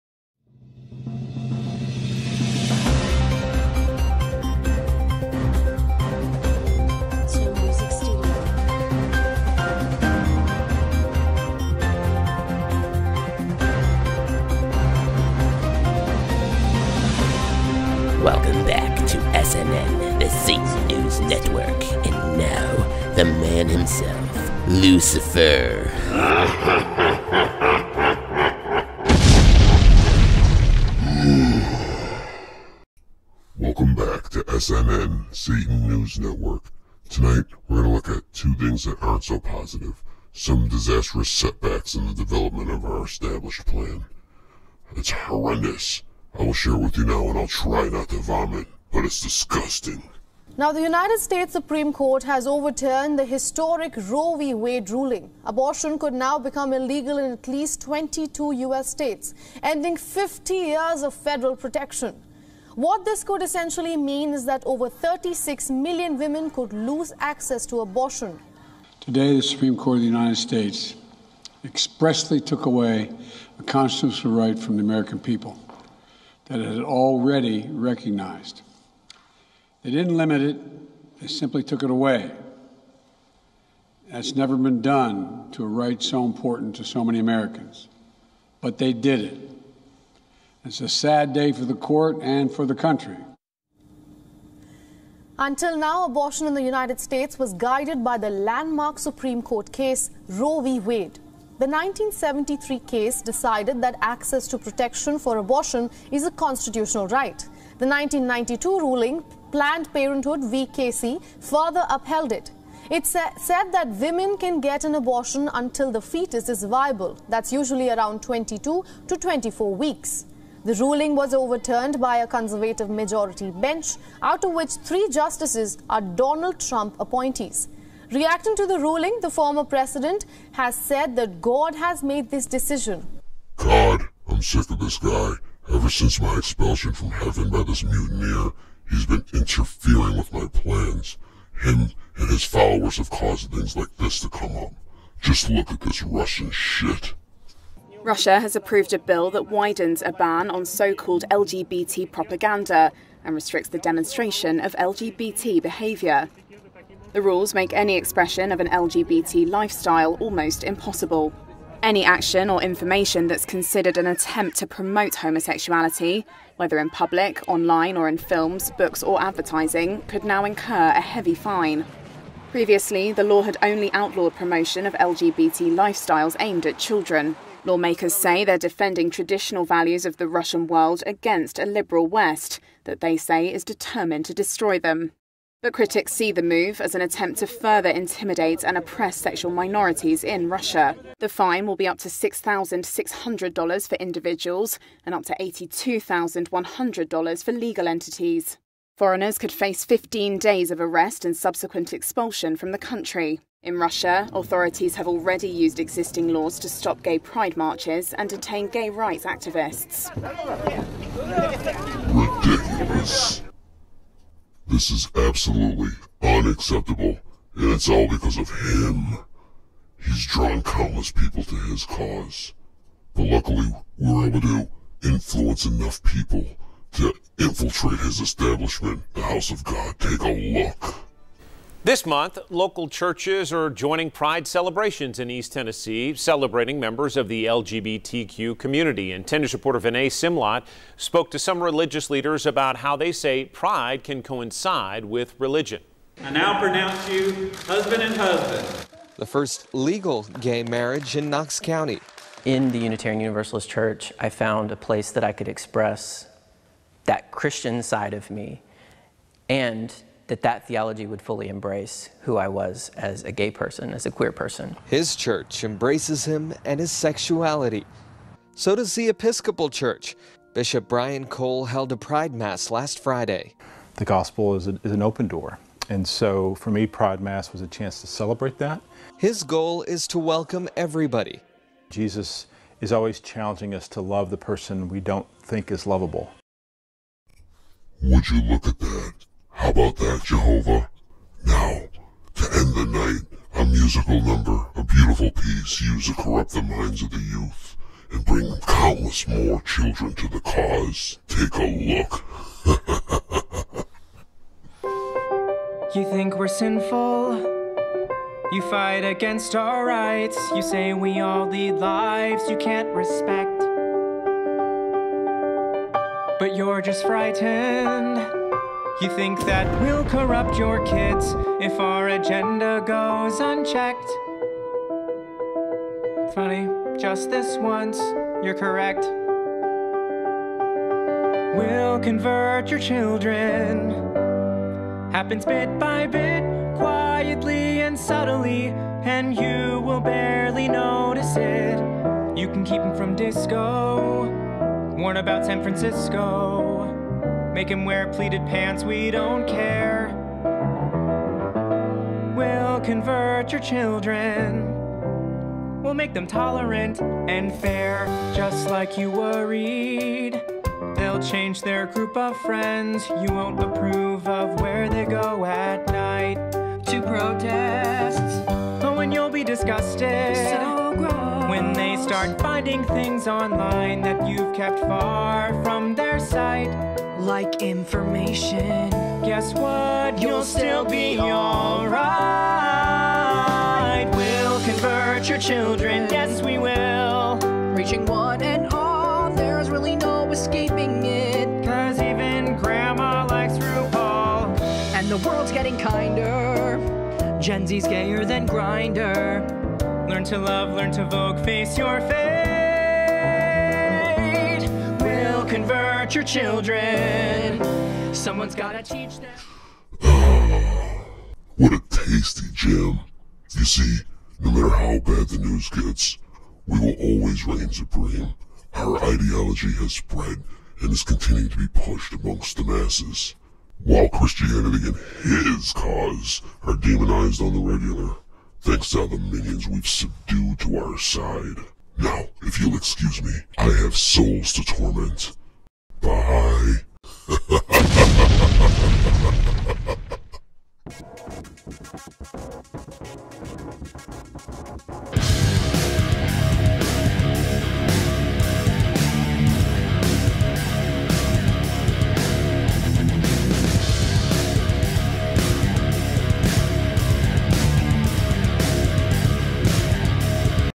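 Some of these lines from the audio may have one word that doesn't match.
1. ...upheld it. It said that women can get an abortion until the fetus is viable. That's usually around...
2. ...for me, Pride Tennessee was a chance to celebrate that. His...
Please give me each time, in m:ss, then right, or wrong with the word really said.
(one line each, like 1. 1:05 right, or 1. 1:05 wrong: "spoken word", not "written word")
1. 1:51 right
2. 4:36 wrong: "Mass", not "Tennessee".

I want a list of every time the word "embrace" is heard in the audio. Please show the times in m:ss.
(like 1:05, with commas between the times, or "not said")
4:21, 4:25.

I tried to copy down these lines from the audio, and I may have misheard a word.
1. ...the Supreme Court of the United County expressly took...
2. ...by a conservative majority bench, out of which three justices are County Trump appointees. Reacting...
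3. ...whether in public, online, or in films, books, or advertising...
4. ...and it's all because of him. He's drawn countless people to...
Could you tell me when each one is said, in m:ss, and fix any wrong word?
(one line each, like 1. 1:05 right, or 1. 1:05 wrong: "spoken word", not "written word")
1. 1:09 wrong: "States", not "County"
2. 2:01 wrong: "Donald", not "County"
3. 2:46 right
4. 3:37 right.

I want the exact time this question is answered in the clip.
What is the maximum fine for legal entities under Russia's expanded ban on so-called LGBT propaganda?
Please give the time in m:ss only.
3:15.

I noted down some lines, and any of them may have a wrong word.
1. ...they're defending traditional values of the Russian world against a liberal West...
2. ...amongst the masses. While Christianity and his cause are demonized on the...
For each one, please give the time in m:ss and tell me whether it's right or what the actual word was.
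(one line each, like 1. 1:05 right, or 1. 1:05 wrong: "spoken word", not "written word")
1. 2:58 right
2. 7:02 right.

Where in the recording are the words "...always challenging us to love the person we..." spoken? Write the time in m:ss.
4:42.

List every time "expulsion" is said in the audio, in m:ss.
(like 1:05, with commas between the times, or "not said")
2:16, 3:21.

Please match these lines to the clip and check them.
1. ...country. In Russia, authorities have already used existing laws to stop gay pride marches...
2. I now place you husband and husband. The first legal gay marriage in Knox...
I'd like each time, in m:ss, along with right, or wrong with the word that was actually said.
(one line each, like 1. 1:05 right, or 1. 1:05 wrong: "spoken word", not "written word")
1. 3:22 right
2. 4:06 wrong: "pronounce", not "place".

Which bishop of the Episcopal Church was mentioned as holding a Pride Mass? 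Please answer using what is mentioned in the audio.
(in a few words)
Brian Cole.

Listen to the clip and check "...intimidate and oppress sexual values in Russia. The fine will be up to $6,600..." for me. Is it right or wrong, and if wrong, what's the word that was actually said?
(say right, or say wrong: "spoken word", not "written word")
wrong: "minorities", not "values".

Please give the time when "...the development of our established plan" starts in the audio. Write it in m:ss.
0:42.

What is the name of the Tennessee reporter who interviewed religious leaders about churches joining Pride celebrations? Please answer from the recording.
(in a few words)
Vinay Simlot.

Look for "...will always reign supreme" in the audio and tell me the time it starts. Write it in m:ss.
6:56.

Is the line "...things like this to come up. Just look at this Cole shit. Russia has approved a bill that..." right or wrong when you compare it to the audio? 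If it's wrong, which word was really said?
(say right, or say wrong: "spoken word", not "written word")
wrong: "Russian", not "Cole".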